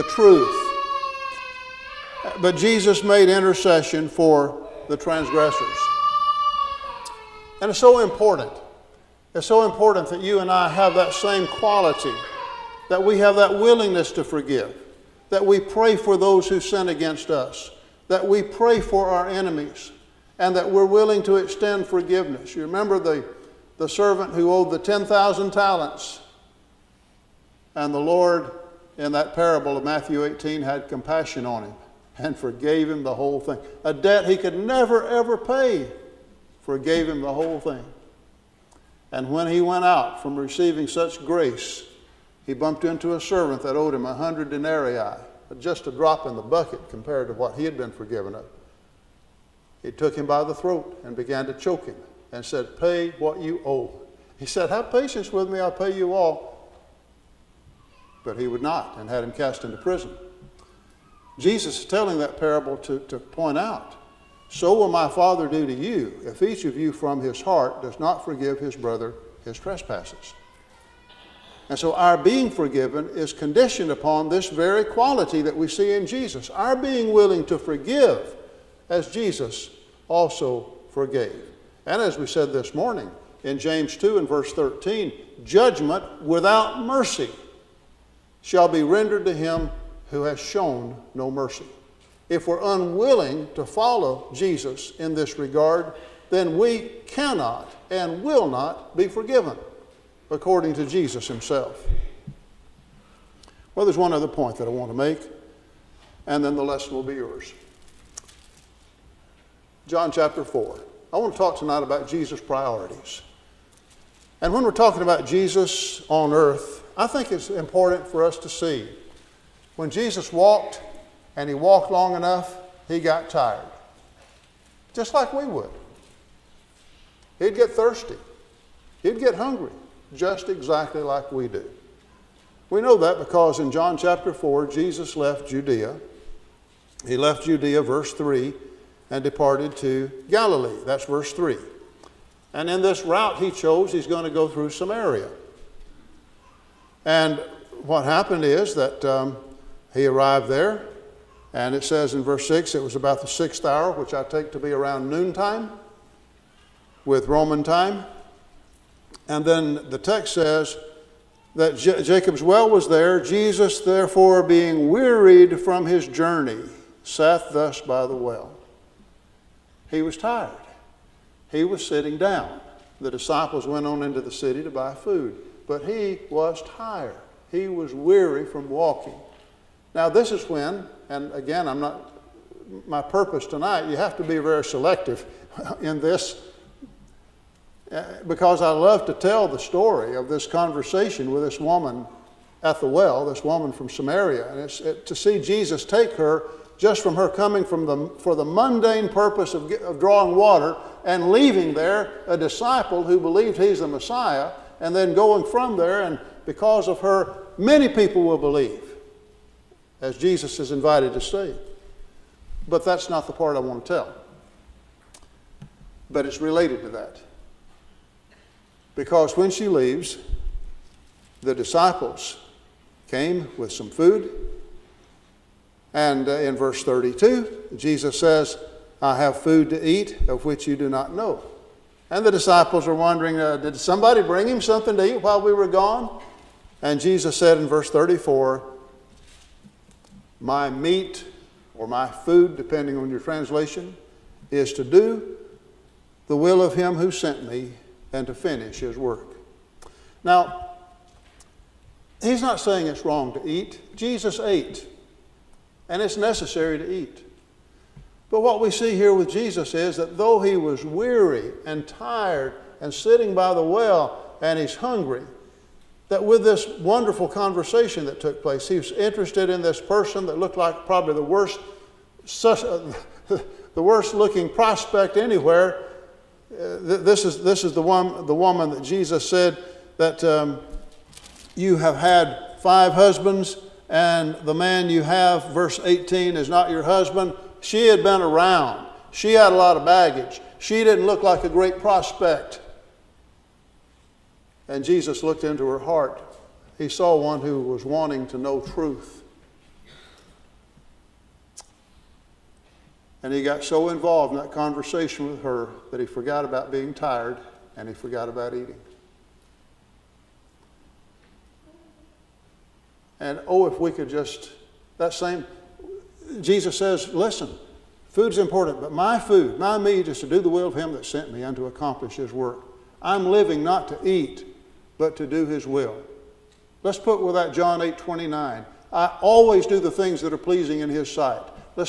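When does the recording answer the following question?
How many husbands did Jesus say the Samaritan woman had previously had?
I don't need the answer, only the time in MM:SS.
04:42.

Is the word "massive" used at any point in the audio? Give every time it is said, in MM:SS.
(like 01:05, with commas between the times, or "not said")
not said.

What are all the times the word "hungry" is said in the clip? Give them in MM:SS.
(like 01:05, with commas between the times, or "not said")
02:09, 04:24.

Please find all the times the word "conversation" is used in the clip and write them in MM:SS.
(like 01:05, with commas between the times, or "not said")
03:10, 04:27, 05:04.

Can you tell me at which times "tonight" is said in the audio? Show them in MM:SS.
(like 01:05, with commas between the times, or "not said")
01:51, 03:03.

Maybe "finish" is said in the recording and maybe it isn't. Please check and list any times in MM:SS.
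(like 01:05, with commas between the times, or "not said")
04:08.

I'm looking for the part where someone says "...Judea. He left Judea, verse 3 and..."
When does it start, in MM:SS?
02:15.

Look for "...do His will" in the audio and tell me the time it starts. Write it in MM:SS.
05:25.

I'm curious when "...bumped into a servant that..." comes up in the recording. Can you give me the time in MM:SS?
00:42.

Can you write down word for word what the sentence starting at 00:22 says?
You remember the the servant who owed the 10,000 talents.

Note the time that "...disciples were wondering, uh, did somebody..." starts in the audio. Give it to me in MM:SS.
03:52.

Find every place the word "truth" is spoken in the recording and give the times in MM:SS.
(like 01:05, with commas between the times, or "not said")
00:00, 04:58.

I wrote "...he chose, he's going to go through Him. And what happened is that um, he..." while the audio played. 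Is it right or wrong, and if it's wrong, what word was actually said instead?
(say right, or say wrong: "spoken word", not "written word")
wrong: "Samaria", not "Him".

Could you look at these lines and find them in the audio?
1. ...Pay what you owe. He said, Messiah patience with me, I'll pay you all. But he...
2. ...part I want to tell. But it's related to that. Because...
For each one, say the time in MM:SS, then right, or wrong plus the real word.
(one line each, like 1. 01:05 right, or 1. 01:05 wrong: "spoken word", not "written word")
1. 00:52 wrong: "Have", not "Messiah"
2. 03:33 right.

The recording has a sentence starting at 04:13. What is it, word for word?
Jesus ate and it's necessary to eat.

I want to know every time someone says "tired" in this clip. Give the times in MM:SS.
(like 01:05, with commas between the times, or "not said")
02:03, 02:50, 02:56, 04:21, 05:06.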